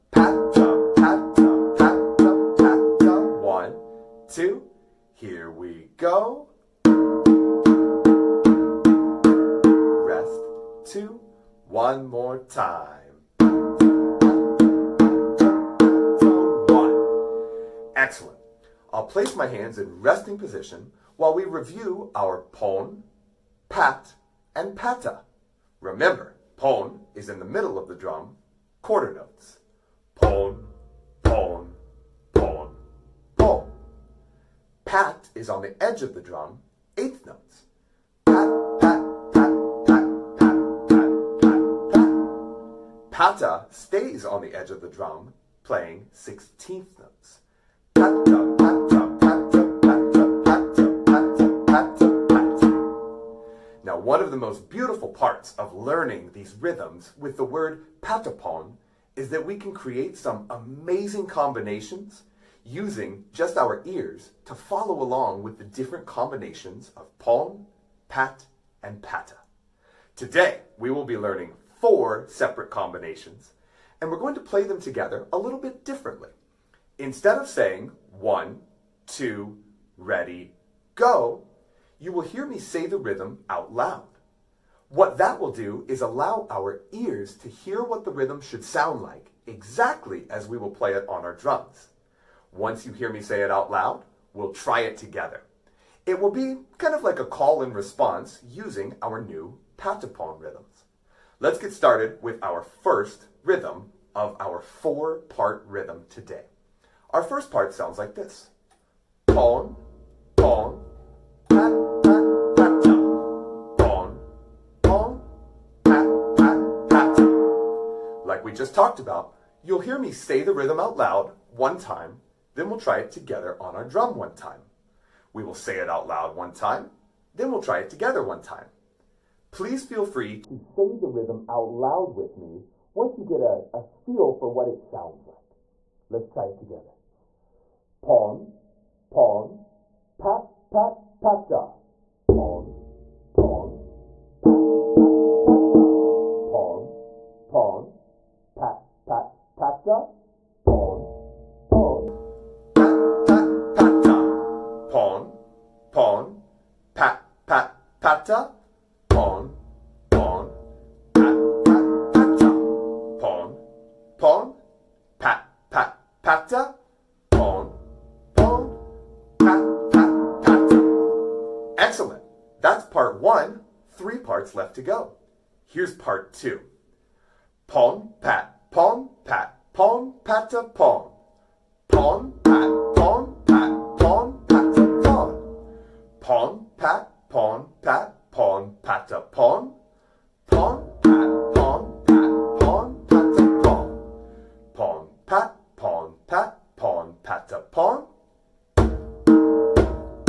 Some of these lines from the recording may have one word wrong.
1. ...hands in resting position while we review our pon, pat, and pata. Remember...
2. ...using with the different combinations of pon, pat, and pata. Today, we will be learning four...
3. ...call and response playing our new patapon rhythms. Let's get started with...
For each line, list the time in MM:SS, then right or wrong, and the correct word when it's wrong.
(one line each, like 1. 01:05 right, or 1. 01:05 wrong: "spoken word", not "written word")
1. 00:19 right
2. 01:05 wrong: "along", not "using"
3. 01:37 wrong: "using", not "playing".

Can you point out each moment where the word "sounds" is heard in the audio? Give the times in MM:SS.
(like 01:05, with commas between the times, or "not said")
01:28, 01:47, 02:14.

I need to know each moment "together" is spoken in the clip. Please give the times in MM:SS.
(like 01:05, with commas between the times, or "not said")
01:14, 01:34, 02:03, 02:07, 02:16.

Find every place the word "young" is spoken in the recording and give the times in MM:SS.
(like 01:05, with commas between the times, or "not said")
not said.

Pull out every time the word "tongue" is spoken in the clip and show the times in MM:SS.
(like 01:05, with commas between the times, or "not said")
not said.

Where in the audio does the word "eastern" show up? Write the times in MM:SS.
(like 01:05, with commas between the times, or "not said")
not said.